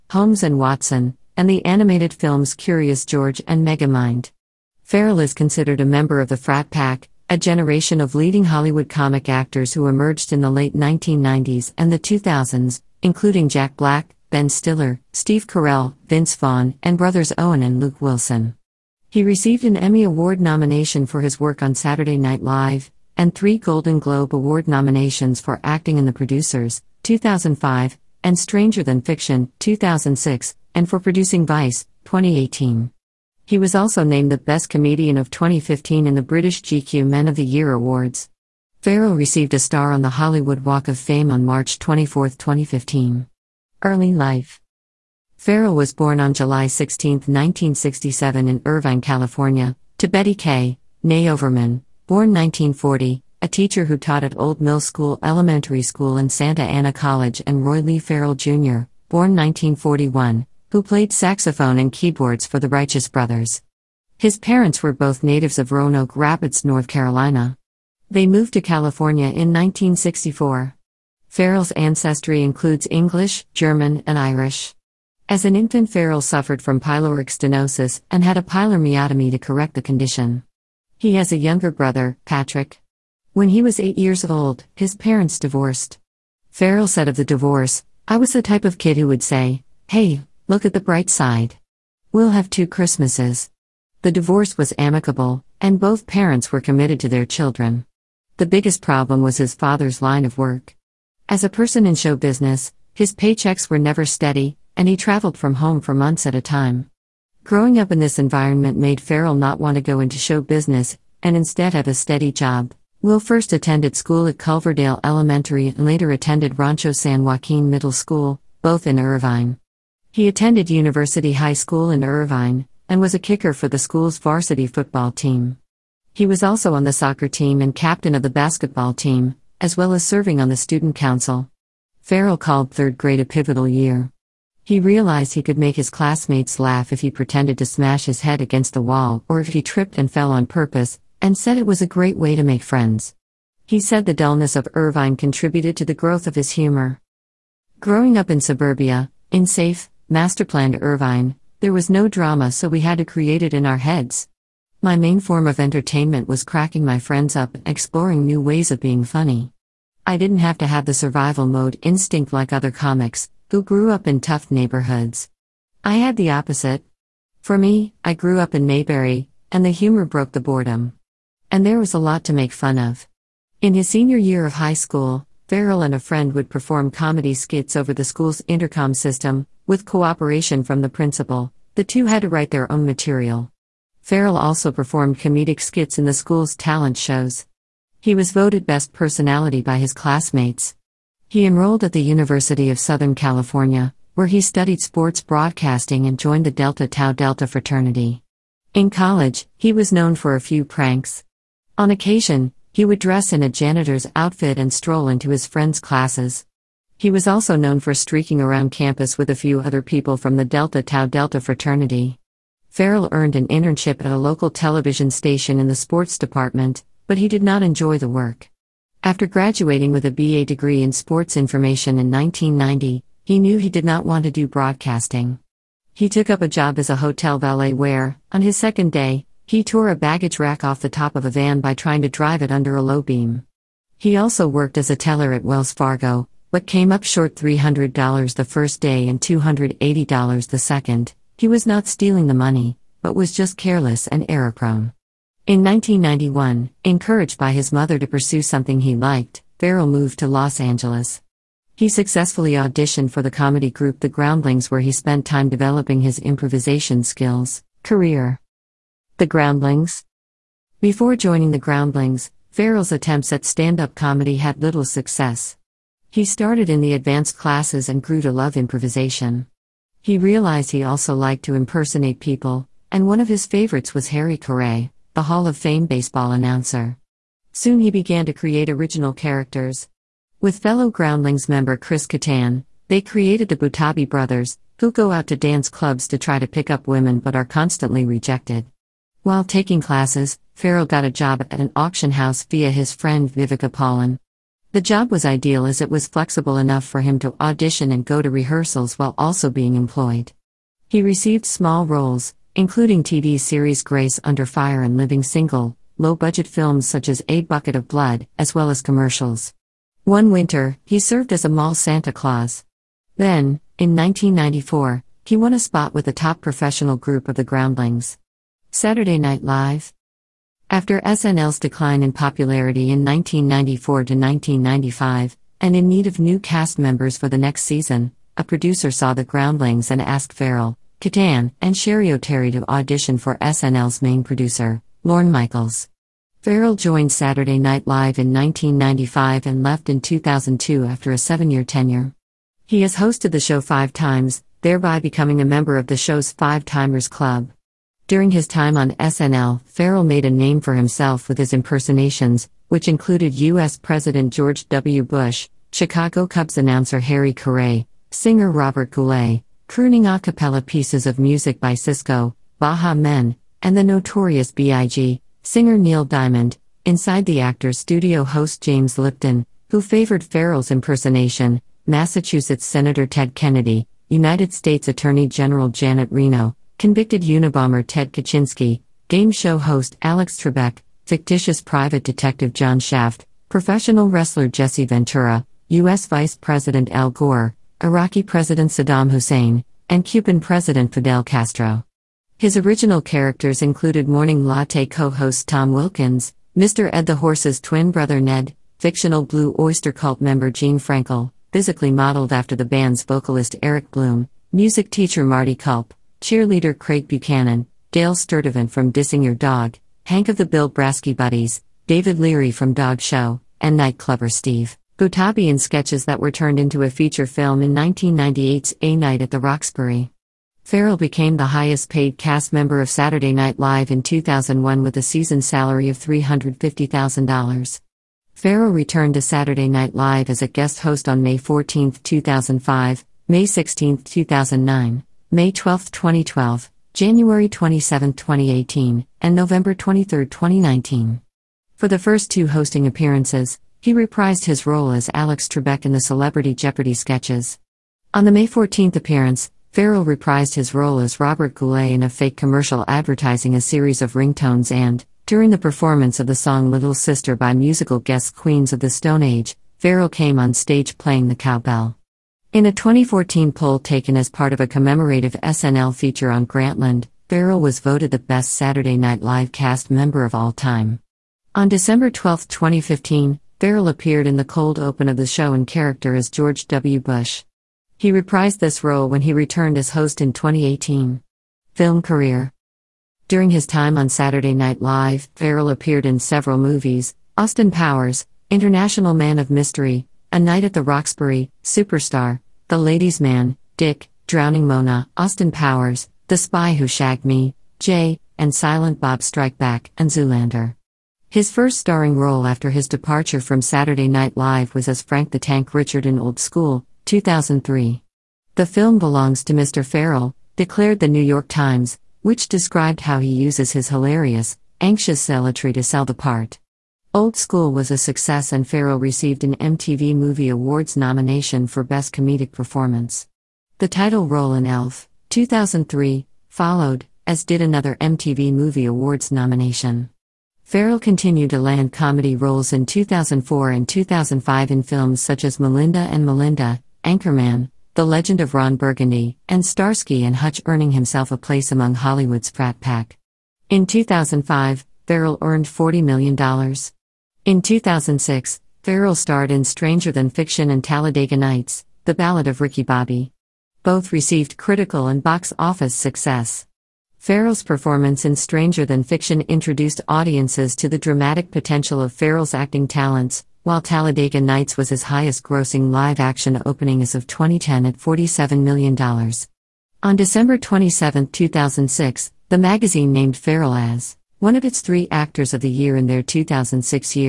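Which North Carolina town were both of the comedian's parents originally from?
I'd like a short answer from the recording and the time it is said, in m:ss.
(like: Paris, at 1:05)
Roanoke Rapids, at 1:05.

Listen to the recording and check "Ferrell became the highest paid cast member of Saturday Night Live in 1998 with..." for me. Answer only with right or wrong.
wrong.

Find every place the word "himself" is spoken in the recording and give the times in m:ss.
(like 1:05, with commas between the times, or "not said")
5:50, 9:00.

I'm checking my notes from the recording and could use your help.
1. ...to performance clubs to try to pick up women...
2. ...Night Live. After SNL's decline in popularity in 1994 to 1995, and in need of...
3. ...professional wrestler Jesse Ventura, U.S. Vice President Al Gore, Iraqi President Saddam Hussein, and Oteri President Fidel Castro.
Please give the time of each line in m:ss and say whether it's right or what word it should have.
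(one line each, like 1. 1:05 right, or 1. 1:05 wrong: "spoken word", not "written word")
1. 4:45 wrong: "dance", not "performance"
2. 5:19 right
3. 6:23 wrong: "Cuban", not "Oteri".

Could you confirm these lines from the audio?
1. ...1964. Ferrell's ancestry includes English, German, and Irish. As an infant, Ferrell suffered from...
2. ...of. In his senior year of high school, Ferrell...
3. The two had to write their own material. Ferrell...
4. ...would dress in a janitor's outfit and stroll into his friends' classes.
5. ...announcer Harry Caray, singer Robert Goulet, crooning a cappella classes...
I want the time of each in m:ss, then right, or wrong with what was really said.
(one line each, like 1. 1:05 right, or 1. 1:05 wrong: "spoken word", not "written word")
1. 1:09 right
2. 2:52 right
3. 3:01 right
4. 3:22 right
5. 5:56 wrong: "pieces", not "classes".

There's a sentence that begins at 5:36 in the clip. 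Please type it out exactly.
Ferrell joined Saturday Night Live in 1995 and left in 2002 after a seven year tenure.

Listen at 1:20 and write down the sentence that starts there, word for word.
He has a younger brother, Patrick.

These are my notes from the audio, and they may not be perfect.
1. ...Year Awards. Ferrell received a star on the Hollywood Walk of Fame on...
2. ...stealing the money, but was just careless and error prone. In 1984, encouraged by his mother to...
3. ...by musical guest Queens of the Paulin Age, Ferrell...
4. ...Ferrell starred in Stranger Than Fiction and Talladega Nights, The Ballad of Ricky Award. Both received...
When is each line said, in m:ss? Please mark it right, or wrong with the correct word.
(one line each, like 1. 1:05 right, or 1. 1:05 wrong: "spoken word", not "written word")
1. 0:37 right
2. 4:01 wrong: "1991", not "1984"
3. 7:37 wrong: "Stone", not "Paulin"
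4. 9:08 wrong: "Bobby", not "Award".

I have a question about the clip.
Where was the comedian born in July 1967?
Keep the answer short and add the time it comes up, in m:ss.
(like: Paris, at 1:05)
Irvine, California, at 0:48.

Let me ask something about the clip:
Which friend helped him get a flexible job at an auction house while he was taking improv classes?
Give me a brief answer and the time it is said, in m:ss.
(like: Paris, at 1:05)
Viveca Paulin, at 4:53.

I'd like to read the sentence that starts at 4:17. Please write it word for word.
Career The Groundlings Before joining The Groundlings, Ferrell's attempts at stand up comedy had little success.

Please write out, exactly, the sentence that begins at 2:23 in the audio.
He said the dullness of Irvine contributed to the growth of his humor.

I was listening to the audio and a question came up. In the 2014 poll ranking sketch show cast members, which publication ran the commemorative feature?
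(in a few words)
Grantland.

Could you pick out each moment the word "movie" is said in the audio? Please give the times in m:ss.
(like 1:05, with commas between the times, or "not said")
8:06, 8:40, 8:48.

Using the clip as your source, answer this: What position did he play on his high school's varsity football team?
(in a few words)
Kicker.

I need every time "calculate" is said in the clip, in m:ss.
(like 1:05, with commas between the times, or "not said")
not said.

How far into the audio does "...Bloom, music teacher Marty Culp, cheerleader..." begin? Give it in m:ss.
6:43.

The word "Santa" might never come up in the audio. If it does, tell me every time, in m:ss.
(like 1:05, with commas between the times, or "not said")
0:56, 5:11.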